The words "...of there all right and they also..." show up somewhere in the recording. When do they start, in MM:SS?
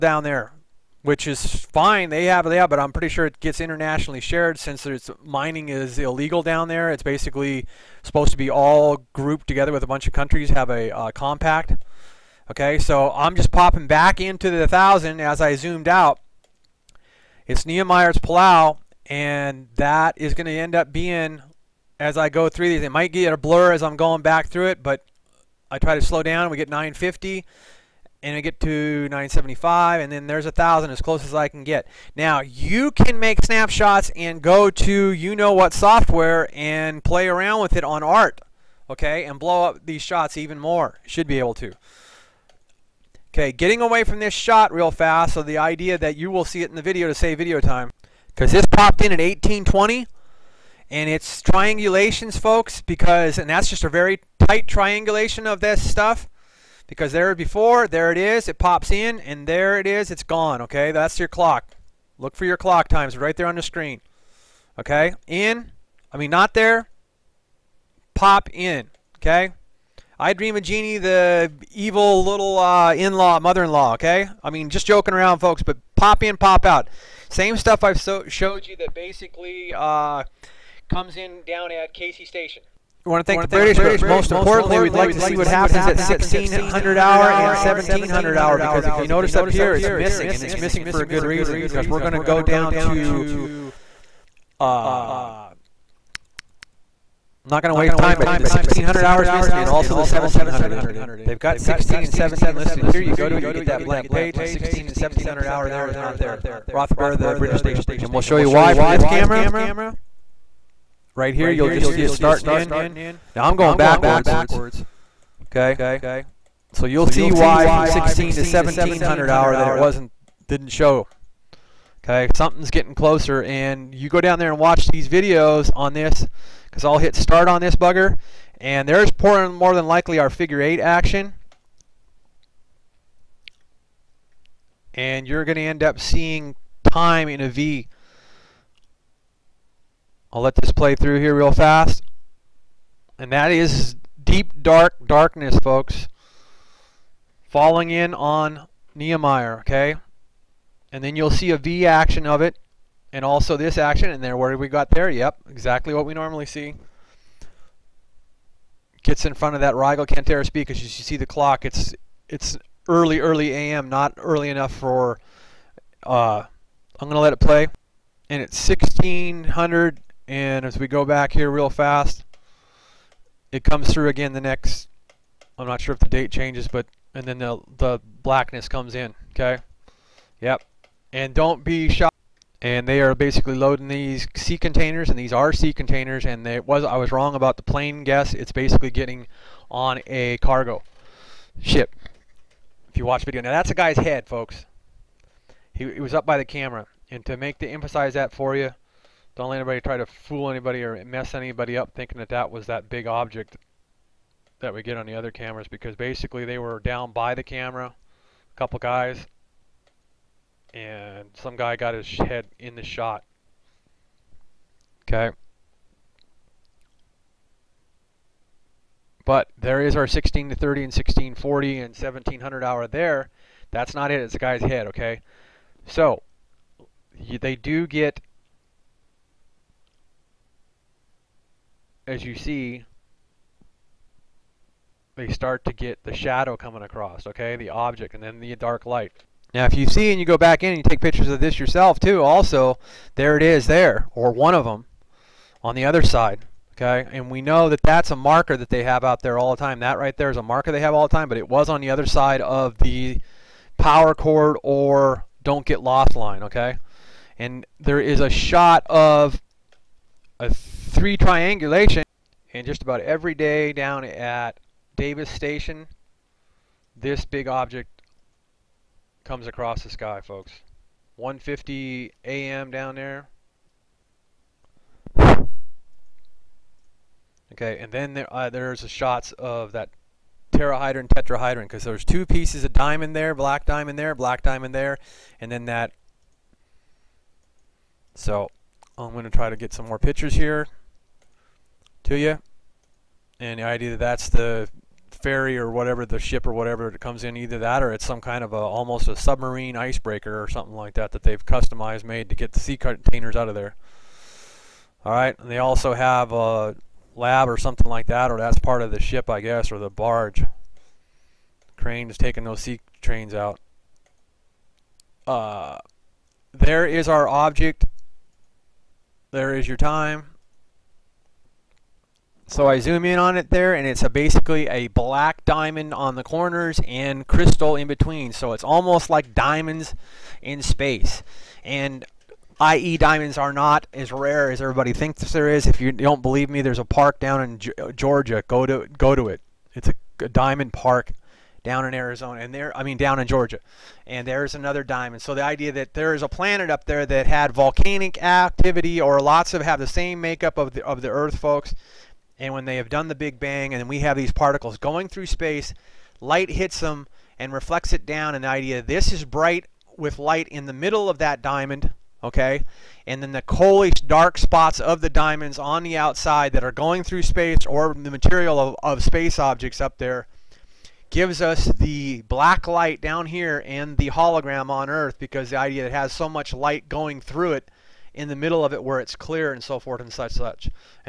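05:03.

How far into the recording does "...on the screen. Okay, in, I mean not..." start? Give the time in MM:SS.
01:03.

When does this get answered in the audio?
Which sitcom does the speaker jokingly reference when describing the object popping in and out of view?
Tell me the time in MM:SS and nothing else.
01:10.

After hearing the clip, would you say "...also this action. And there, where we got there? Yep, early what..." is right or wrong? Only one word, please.
wrong.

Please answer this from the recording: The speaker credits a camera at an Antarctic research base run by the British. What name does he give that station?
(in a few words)
Rothenberg.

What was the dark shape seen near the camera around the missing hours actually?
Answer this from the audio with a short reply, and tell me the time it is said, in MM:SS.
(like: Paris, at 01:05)
A guy's head, at 03:13.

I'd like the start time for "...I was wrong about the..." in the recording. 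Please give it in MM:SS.
03:06.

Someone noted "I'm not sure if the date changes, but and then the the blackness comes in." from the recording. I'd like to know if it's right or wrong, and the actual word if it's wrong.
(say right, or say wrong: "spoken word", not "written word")
right.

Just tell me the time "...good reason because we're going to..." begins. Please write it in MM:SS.
01:31.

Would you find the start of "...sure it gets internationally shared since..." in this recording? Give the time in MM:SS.
00:03.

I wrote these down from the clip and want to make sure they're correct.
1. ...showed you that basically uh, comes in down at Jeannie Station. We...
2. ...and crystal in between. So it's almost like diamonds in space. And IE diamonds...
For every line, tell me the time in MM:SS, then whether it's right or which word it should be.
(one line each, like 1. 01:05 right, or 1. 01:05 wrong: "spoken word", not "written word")
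1. 01:18 wrong: "Casey", not "Jeannie"
2. 05:26 right.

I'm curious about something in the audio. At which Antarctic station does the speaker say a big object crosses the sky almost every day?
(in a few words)
Davis Station.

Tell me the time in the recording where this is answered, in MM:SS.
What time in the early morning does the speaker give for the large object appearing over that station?
04:31.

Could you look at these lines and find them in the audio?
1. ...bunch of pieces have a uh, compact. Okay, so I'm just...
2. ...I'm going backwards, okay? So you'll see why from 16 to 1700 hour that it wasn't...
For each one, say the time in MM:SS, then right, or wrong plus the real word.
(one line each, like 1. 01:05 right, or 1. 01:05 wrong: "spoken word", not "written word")
1. 00:09 wrong: "countries", not "pieces"
2. 01:53 right.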